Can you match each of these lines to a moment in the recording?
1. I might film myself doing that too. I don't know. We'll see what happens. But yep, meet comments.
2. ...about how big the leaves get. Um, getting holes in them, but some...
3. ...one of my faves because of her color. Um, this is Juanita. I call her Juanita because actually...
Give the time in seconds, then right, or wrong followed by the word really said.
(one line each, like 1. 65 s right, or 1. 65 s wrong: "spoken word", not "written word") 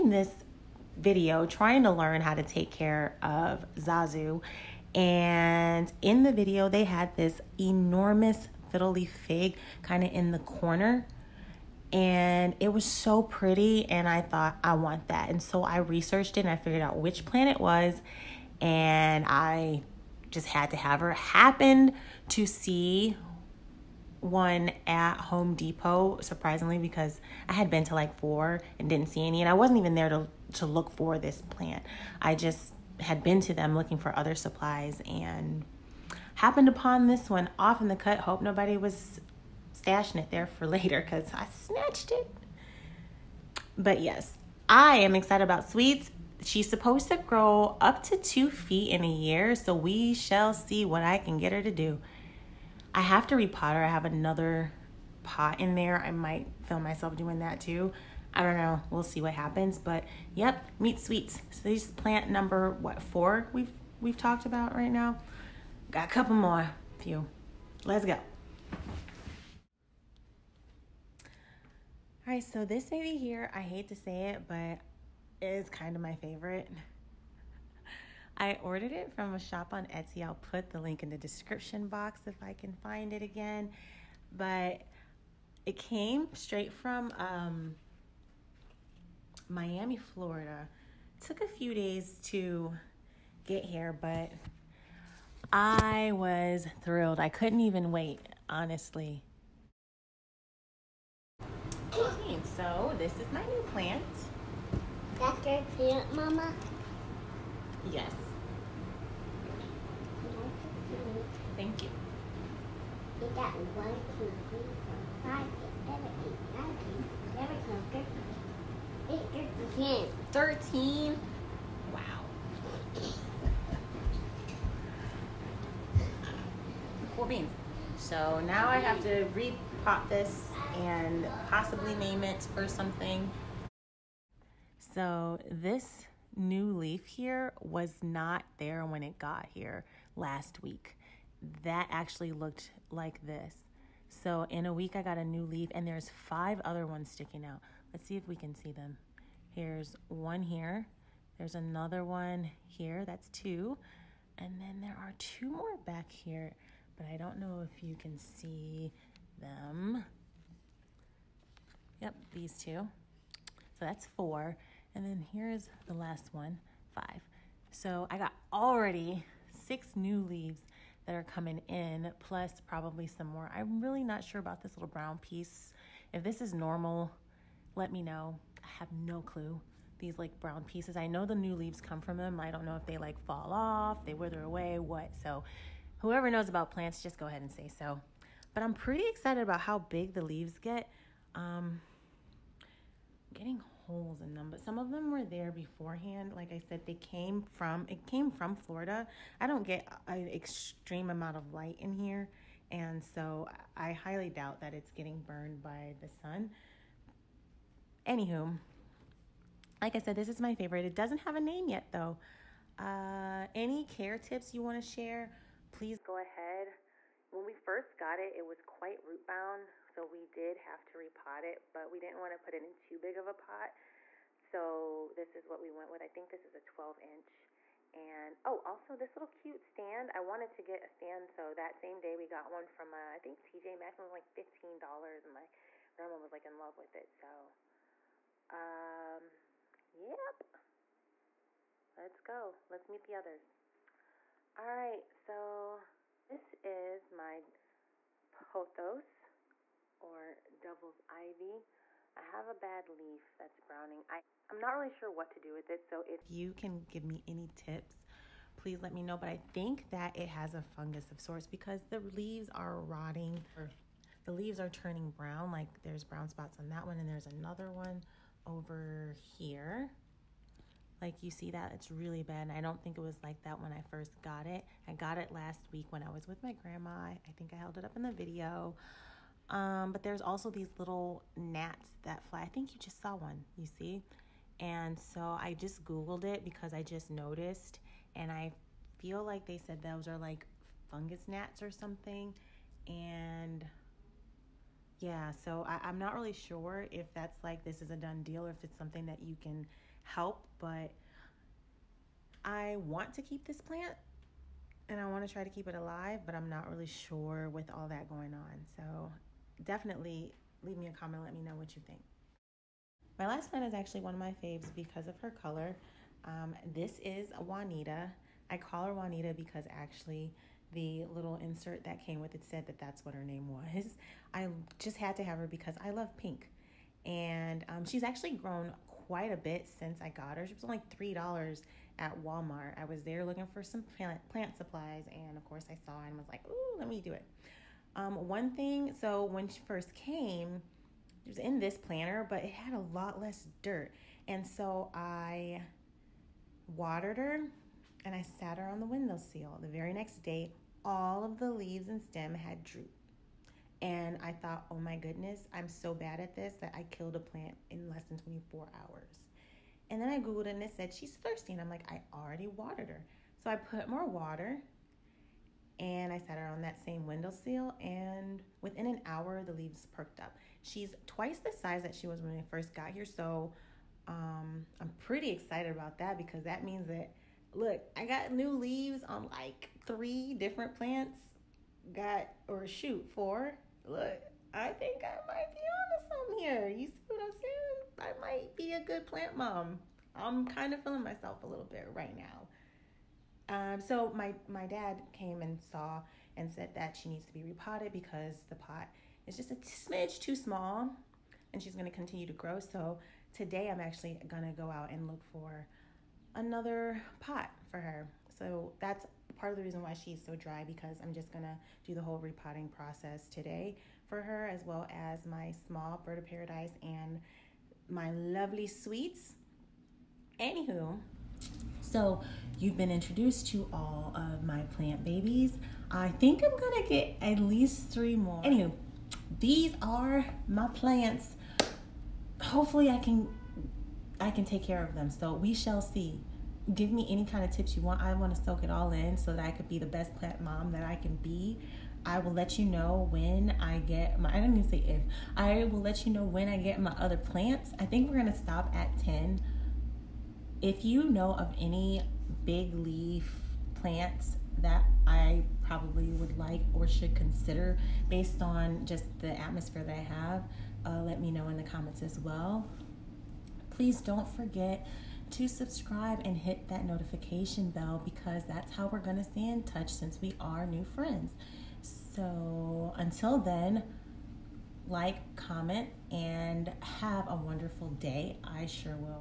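1. 56 s wrong: "sweets", not "comments"
2. 189 s right
3. 313 s right.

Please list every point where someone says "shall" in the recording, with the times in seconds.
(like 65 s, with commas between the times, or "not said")
50 s, 435 s.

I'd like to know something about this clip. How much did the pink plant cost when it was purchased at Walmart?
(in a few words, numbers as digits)
$3.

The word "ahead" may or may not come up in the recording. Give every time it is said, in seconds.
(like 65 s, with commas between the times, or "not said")
187 s, 216 s.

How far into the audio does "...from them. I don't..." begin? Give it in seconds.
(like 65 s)
182 s.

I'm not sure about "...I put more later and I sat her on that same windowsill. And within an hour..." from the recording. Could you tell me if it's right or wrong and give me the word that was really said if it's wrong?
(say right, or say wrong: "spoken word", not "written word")
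wrong: "water", not "later".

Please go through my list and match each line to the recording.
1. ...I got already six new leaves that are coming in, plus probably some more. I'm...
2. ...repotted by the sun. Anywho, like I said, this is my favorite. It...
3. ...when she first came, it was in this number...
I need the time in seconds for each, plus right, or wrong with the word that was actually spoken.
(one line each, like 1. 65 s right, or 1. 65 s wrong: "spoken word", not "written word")
1. 168 s right
2. 205 s wrong: "burned", not "repotted"
3. 339 s wrong: "planter", not "number".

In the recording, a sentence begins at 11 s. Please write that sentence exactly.
And it was so pretty, and I thought, I want that.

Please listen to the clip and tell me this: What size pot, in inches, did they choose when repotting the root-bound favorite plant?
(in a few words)
12 inch.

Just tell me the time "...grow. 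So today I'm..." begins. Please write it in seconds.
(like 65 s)
402 s.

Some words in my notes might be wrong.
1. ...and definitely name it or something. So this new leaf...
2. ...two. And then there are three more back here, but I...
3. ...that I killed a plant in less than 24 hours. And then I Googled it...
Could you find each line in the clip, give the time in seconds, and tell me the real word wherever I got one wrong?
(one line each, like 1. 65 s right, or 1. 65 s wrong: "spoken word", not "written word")
1. 130 s wrong: "possibly", not "definitely"
2. 153 s wrong: "two", not "three"
3. 356 s right.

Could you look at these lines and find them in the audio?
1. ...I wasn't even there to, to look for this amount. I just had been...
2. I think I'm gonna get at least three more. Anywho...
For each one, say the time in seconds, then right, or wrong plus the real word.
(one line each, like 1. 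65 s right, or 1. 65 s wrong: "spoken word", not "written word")
1. 29 s wrong: "plant", not "amount"
2. 425 s right.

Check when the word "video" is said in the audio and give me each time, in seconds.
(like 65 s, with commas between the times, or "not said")
0 s, 6 s, 278 s.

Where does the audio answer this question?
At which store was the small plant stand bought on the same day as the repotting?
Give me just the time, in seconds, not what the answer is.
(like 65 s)
233 s.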